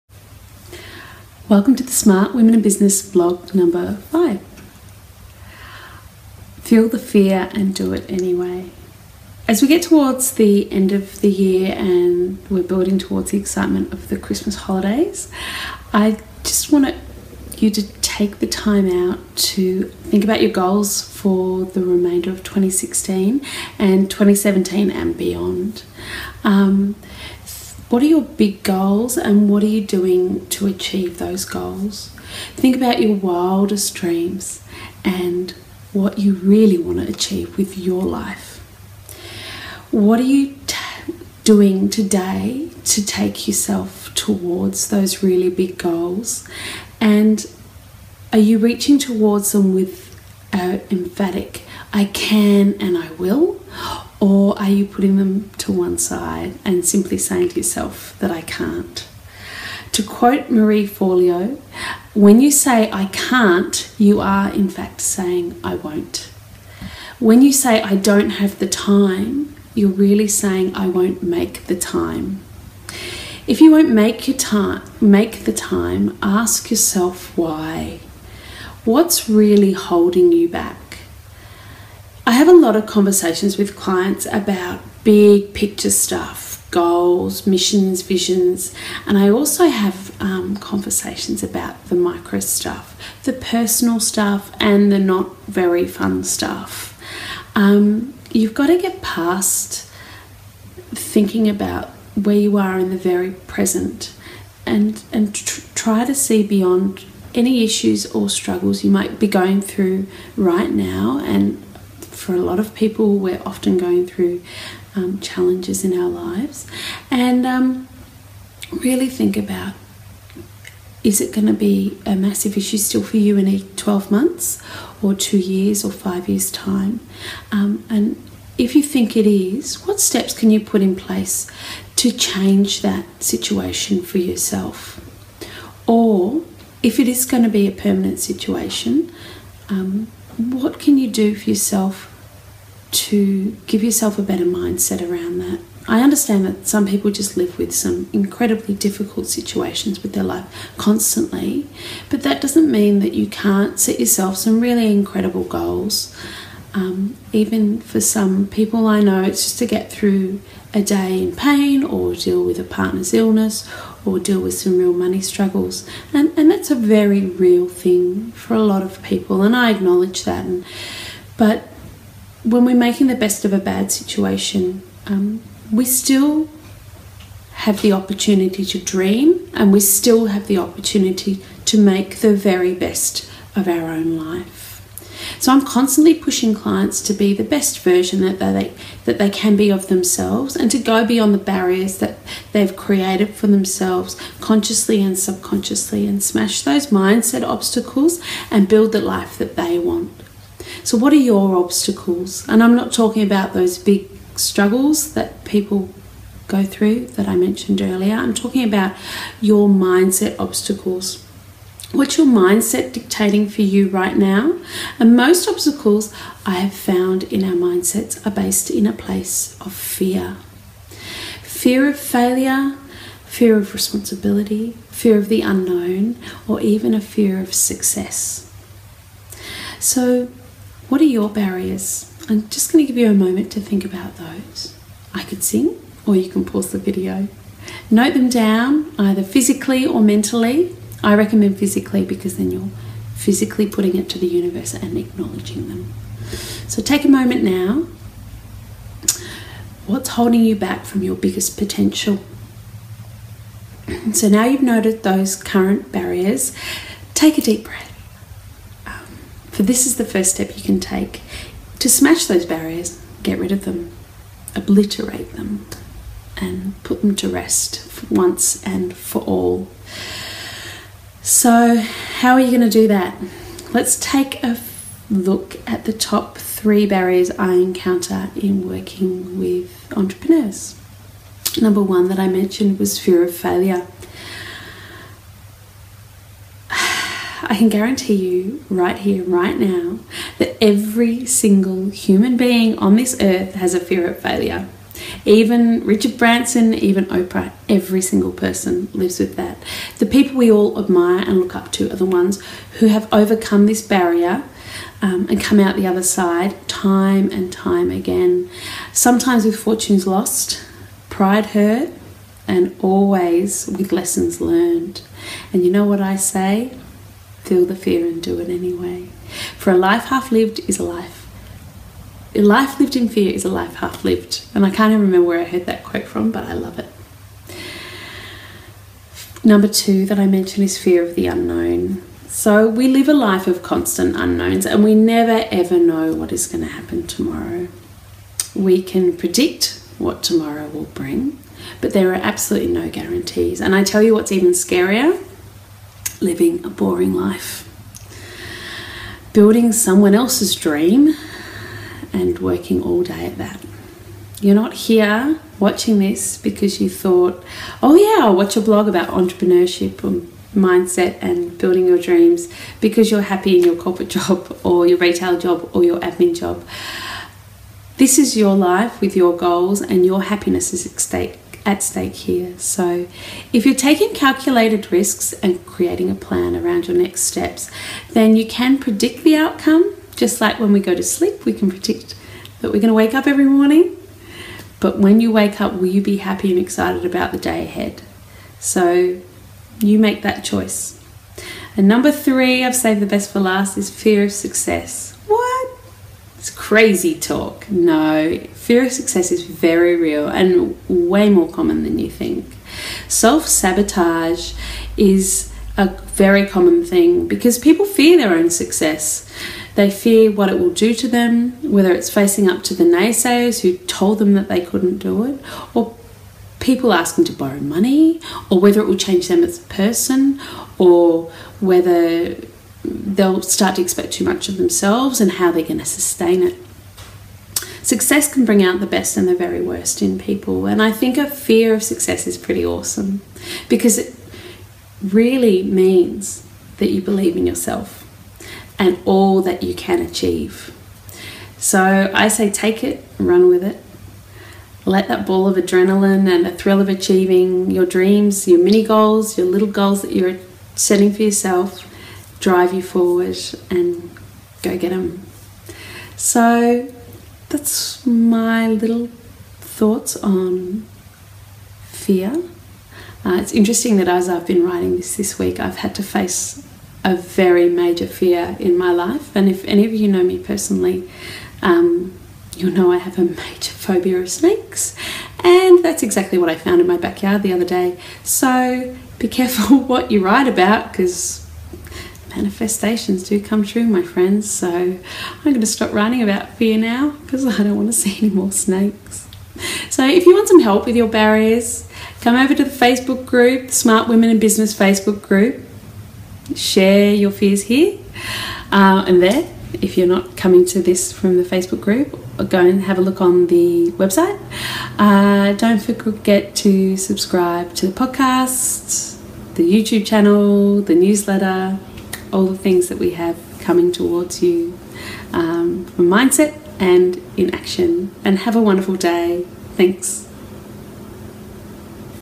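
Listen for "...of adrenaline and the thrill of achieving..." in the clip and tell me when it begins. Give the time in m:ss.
7:25.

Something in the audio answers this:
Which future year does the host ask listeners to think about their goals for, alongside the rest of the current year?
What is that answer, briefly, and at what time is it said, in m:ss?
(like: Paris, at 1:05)
2017, at 0:24.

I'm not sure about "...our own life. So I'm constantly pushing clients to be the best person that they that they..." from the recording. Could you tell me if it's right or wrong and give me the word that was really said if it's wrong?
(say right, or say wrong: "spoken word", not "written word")
wrong: "version", not "person".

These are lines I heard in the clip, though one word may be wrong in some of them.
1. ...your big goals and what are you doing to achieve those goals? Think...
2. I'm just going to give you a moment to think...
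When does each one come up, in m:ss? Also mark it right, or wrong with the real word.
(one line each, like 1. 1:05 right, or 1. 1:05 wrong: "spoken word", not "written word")
1. 0:28 right
2. 3:52 right.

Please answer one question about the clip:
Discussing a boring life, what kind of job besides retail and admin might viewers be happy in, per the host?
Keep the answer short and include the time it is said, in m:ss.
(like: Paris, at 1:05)
corporate, at 6:03.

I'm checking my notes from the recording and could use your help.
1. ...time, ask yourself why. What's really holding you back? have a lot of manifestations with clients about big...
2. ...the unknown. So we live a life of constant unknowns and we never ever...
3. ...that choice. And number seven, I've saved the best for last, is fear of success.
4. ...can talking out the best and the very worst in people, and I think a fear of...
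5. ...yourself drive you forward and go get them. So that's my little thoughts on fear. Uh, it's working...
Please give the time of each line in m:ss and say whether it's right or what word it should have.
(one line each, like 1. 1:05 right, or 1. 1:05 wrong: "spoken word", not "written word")
1. 1:15 wrong: "conversations", not "manifestations"
2. 5:31 right
3. 6:30 wrong: "three", not "seven"
4. 7:08 wrong: "bring", not "talking"
5. 7:31 wrong: "interesting", not "working".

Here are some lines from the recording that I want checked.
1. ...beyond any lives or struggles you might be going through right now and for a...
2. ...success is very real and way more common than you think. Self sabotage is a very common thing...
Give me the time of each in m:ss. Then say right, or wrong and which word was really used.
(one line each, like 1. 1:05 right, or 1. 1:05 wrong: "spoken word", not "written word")
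1. 1:46 wrong: "issues", not "lives"
2. 6:38 right.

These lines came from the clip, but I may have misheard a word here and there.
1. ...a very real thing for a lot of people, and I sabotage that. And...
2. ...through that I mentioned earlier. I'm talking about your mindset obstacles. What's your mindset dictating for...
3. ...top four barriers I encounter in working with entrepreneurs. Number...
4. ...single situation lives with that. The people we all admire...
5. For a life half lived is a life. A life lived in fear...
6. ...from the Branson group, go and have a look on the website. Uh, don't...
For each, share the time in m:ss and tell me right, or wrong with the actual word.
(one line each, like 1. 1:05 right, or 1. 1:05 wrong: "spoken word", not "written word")
1. 2:46 wrong: "acknowledge", not "sabotage"
2. 3:26 right
3. 4:35 wrong: "three", not "four"
4. 4:58 wrong: "person", not "situation"
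5. 5:19 right
6. 8:21 wrong: "Facebook", not "Branson".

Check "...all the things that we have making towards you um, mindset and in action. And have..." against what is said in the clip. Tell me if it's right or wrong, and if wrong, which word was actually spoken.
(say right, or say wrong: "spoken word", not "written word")
wrong: "coming", not "making".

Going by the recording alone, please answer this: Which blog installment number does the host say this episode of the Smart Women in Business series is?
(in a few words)
5.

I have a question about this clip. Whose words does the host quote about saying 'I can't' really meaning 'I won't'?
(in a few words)
Marie Forleo.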